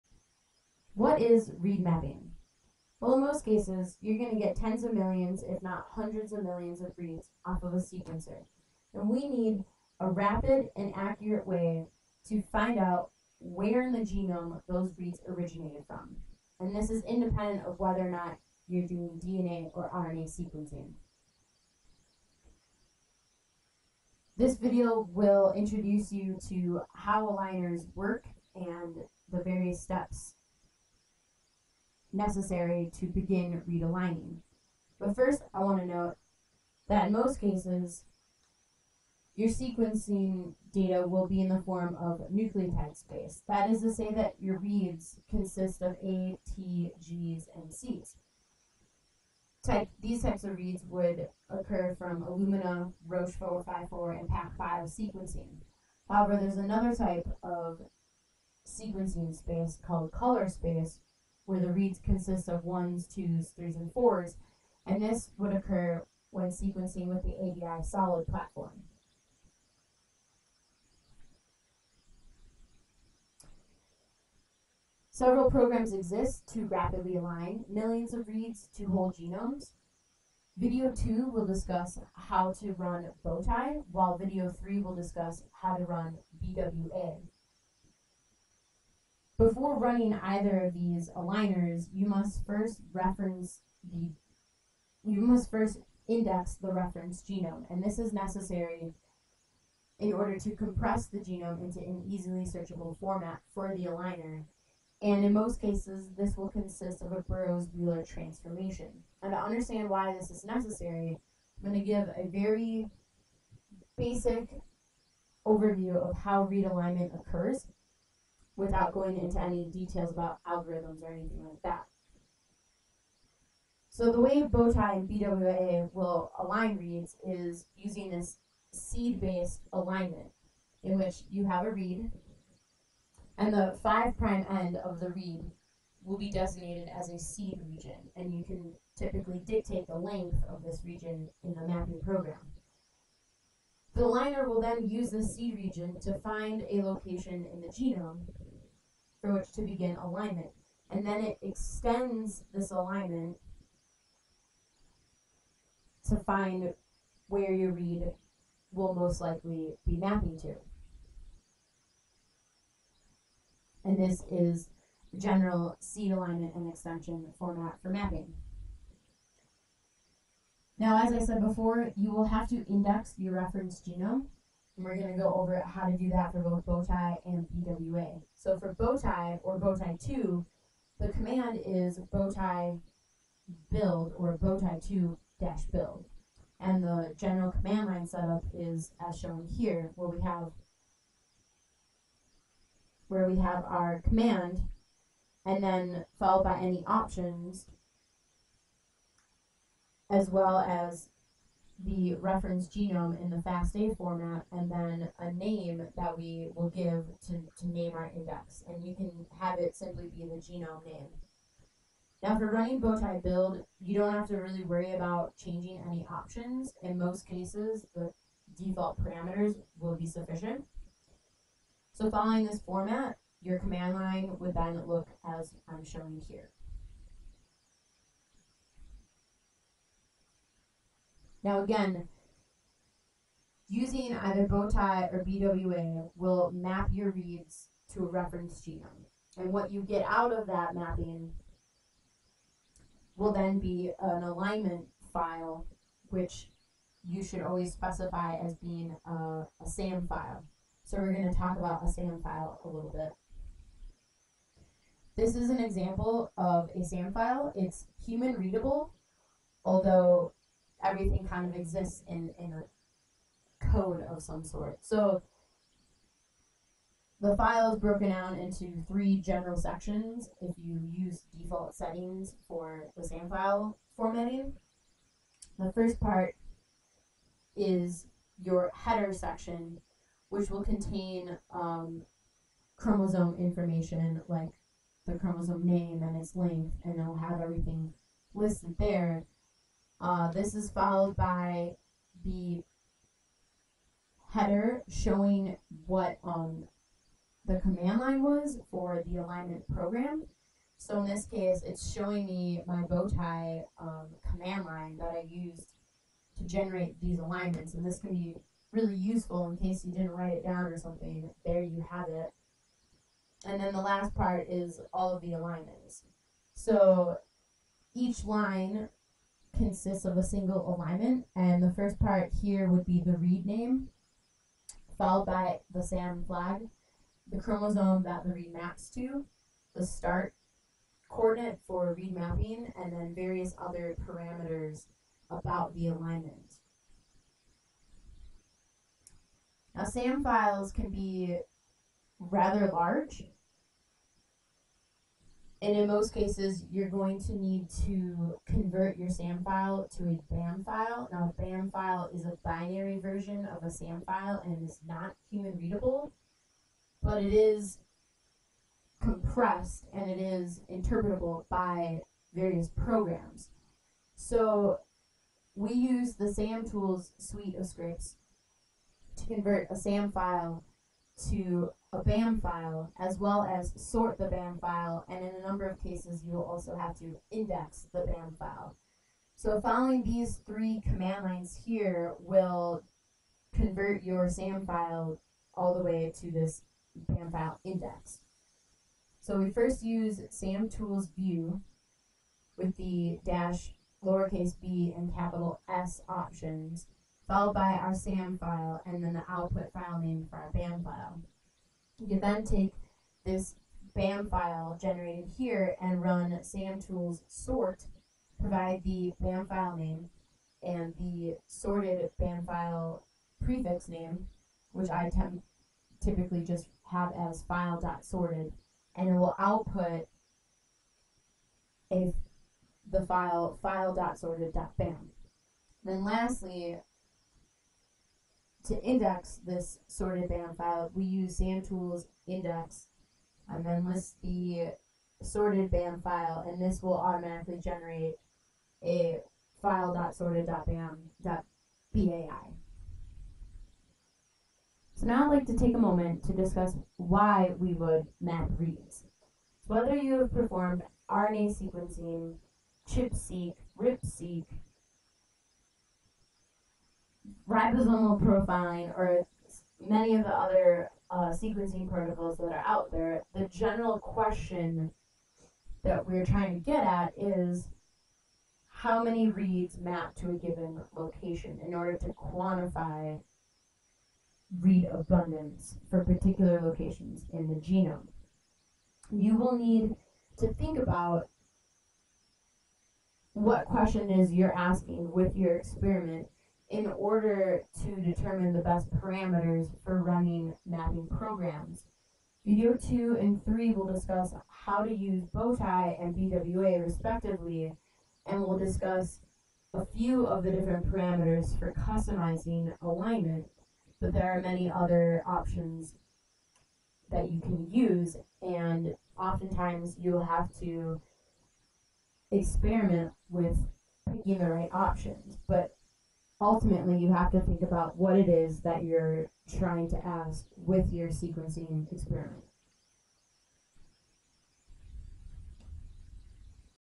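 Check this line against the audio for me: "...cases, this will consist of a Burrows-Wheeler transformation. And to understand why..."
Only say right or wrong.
right.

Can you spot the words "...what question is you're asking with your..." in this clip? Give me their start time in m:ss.
8:03.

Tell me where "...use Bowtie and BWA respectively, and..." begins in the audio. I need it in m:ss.
8:14.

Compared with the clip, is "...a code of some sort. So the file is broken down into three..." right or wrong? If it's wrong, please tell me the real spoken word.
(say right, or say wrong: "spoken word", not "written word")
right.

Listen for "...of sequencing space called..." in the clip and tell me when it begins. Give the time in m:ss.
0:57.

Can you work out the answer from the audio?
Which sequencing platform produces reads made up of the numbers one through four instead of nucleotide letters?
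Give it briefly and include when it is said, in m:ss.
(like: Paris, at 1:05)
ABI SOLiD, at 1:07.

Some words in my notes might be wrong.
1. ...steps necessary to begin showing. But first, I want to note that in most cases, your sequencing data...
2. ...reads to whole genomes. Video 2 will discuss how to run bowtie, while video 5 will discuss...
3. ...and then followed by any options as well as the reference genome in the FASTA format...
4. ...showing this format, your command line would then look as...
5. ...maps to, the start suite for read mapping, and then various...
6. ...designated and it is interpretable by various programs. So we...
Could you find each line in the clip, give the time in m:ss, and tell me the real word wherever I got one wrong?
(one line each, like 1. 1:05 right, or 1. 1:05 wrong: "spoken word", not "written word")
1. 0:29 wrong: "realigning", not "showing"
2. 1:18 wrong: "3", not "5"
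3. 3:15 right
4. 3:42 wrong: "following", not "showing"
5. 5:28 wrong: "coordinate", not "suite"
6. 5:58 wrong: "compressed", not "designated".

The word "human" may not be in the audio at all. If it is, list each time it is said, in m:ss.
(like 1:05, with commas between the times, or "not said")
4:18, 5:55.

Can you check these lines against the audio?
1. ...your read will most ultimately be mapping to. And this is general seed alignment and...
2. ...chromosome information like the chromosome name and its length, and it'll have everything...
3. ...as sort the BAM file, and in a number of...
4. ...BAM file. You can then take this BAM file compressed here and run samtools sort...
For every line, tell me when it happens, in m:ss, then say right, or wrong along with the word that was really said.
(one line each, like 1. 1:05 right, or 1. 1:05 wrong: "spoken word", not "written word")
1. 2:37 wrong: "likely", not "ultimately"
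2. 4:42 right
3. 6:13 right
4. 6:40 wrong: "generated", not "compressed".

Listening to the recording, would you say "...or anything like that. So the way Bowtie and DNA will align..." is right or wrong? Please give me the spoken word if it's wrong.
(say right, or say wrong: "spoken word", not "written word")
wrong: "BWA", not "DNA".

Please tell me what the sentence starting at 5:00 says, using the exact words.
So in this case, it's showing me my Bowtie um, command line that I used to generate these alignments.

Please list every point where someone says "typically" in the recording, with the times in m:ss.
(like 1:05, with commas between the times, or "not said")
2:18, 6:56.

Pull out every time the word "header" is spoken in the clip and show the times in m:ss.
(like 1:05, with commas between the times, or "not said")
4:38, 4:54.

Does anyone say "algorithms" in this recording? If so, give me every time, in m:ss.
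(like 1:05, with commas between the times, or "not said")
2:00.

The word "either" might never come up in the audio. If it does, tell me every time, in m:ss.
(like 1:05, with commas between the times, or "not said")
1:30, 3:54.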